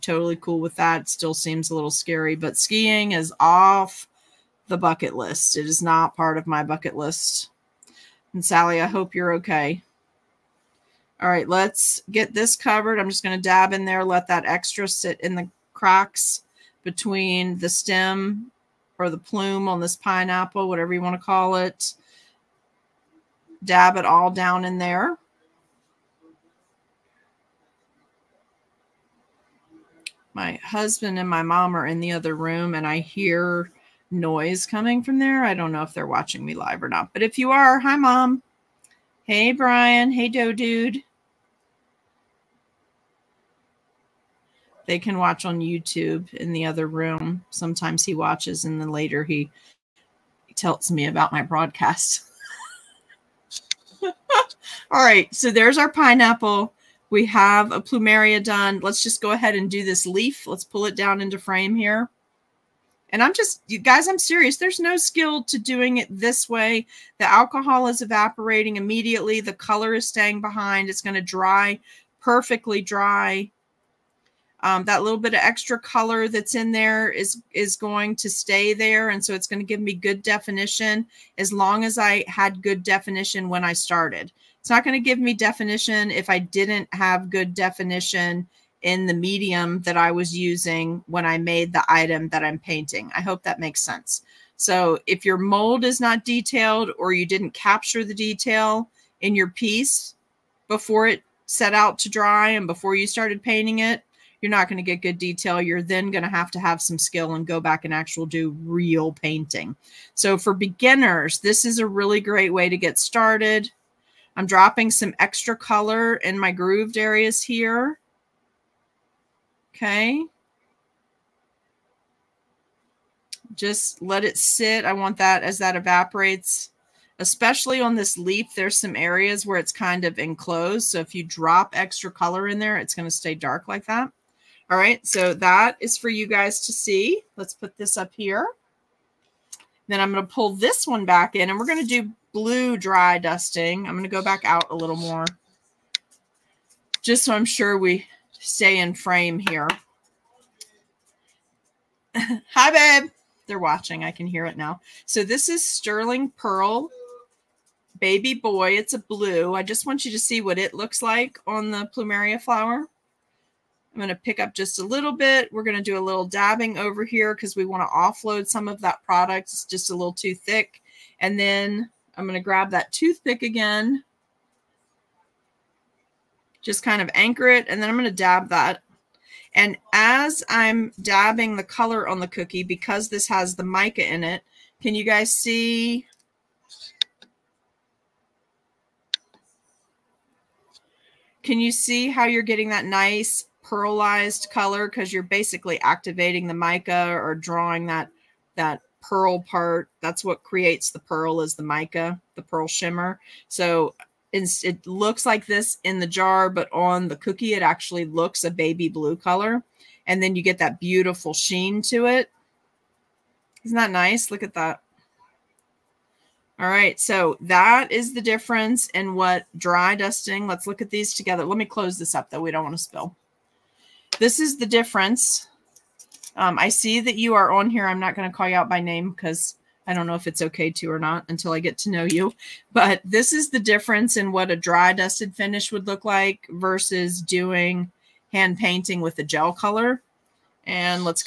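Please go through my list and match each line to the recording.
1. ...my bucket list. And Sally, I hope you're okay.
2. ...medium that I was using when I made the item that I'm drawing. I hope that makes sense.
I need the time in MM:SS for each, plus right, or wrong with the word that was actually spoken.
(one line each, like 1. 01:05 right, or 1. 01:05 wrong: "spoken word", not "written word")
1. 00:06 right
2. 01:29 wrong: "painting", not "drawing".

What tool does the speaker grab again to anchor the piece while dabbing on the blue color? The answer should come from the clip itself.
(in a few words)
toothpick.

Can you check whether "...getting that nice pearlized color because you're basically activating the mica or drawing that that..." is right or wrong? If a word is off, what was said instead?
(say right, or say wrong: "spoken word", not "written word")
right.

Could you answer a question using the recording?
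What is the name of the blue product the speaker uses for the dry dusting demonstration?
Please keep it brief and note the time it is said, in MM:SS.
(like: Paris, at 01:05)
Sterling Pearl Baby Boy, at 02:35.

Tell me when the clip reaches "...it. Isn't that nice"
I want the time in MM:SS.
03:32.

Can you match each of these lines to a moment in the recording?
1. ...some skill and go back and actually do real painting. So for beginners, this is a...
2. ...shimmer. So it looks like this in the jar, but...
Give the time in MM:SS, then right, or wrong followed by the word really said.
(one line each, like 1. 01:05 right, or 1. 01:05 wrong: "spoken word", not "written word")
1. 01:46 right
2. 03:22 right.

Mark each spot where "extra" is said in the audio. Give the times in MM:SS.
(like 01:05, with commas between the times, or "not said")
00:14, 01:15, 01:55, 02:11.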